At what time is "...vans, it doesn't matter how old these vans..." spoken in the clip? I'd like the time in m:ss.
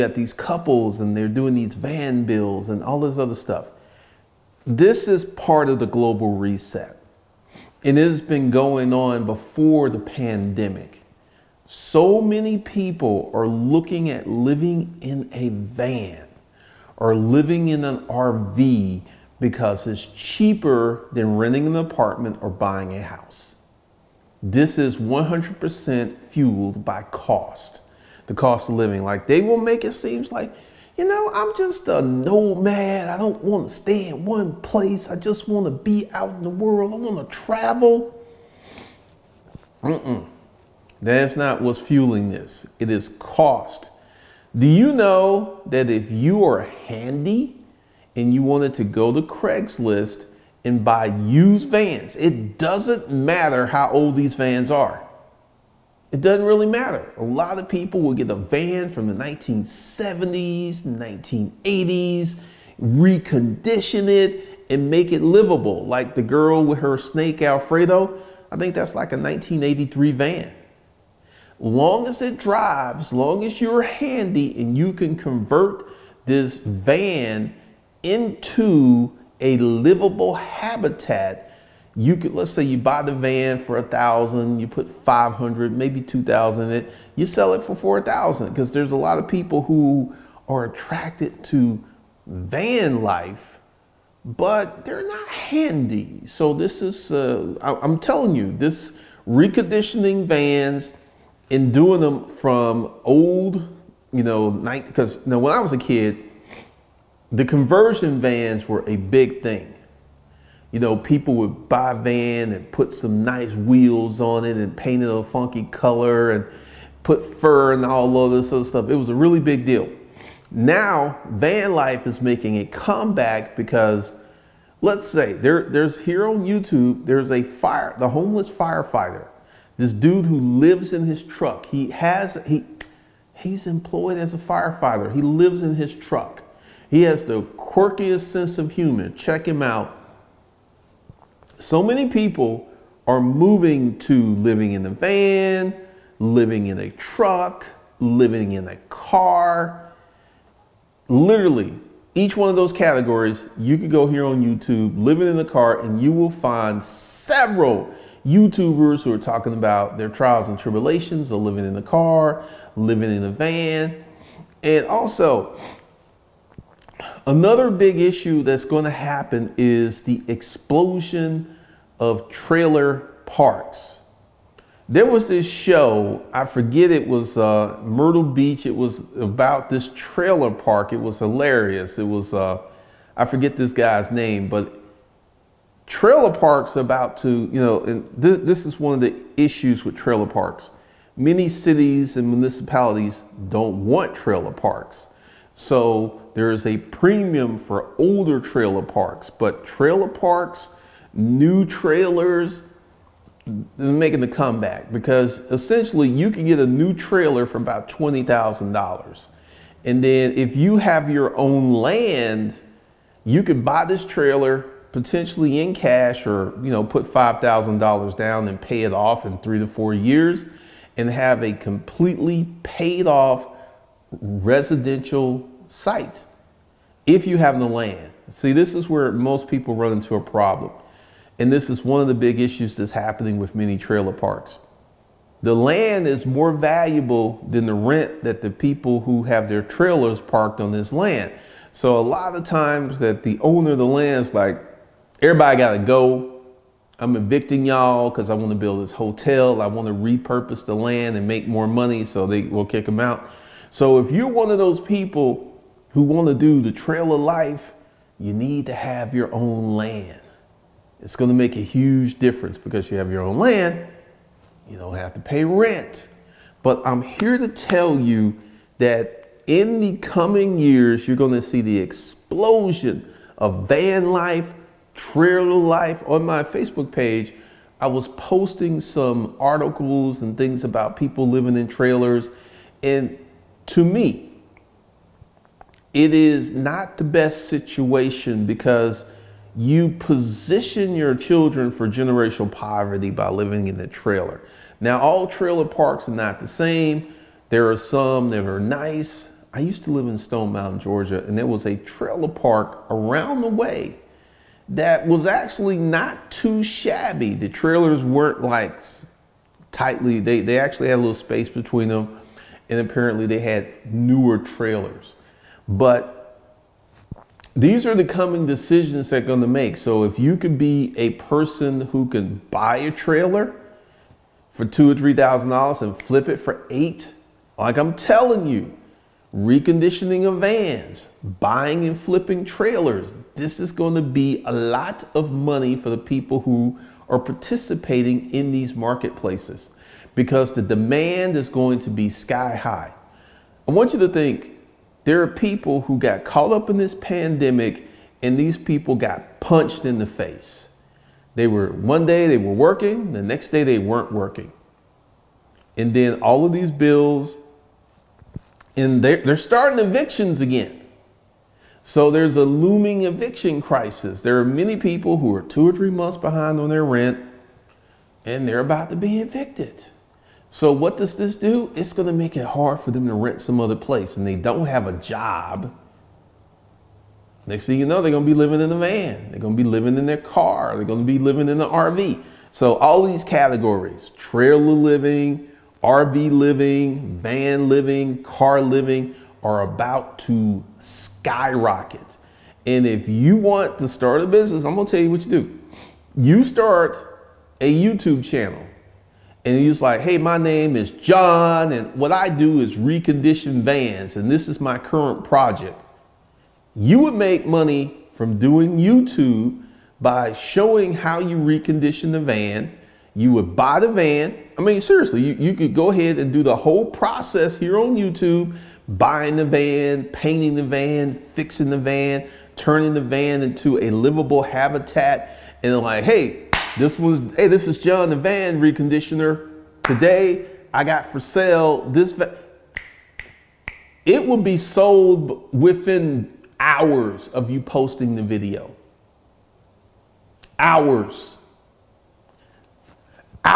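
0:51.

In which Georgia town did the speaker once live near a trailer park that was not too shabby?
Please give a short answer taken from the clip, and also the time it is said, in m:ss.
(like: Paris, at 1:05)
Stone Mountain, at 5:00.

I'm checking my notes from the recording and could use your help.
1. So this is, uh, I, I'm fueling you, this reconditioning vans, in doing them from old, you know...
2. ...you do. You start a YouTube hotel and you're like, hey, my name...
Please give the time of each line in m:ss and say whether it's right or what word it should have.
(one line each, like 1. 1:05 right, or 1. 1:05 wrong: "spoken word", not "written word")
1. 1:36 wrong: "telling", not "fueling"
2. 6:35 wrong: "channel", not "hotel".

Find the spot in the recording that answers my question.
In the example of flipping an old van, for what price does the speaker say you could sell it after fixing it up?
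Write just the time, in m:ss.
1:27.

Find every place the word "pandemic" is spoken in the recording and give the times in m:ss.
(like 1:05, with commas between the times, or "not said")
0:09, 5:46.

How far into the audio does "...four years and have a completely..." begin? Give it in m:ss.
3:39.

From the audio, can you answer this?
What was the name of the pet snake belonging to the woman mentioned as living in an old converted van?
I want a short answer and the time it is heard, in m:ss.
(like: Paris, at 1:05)
Alfredo, at 1:07.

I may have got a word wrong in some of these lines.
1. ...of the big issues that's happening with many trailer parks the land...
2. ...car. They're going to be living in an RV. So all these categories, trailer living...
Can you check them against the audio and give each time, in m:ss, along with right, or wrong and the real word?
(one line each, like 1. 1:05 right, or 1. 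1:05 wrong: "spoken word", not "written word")
1. 3:52 right
2. 6:20 right.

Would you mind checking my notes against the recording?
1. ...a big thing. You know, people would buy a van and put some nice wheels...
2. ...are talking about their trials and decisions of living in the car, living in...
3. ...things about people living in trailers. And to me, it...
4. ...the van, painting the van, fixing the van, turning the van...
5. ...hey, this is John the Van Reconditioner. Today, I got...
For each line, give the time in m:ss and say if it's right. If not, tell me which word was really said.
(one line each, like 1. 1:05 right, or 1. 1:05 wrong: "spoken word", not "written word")
1. 1:48 right
2. 2:39 wrong: "tribulations", not "decisions"
3. 4:40 right
4. 6:59 right
5. 7:07 right.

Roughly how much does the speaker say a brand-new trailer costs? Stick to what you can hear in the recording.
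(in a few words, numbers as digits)
$20,000.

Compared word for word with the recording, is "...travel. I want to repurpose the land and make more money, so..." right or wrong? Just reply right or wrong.
wrong.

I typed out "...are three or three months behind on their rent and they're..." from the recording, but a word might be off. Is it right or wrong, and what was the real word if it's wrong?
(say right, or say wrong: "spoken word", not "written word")
wrong: "two", not "three".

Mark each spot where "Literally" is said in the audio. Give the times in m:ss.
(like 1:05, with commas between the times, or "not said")
2:31.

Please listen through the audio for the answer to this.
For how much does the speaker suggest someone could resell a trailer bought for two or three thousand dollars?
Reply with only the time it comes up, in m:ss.
5:26.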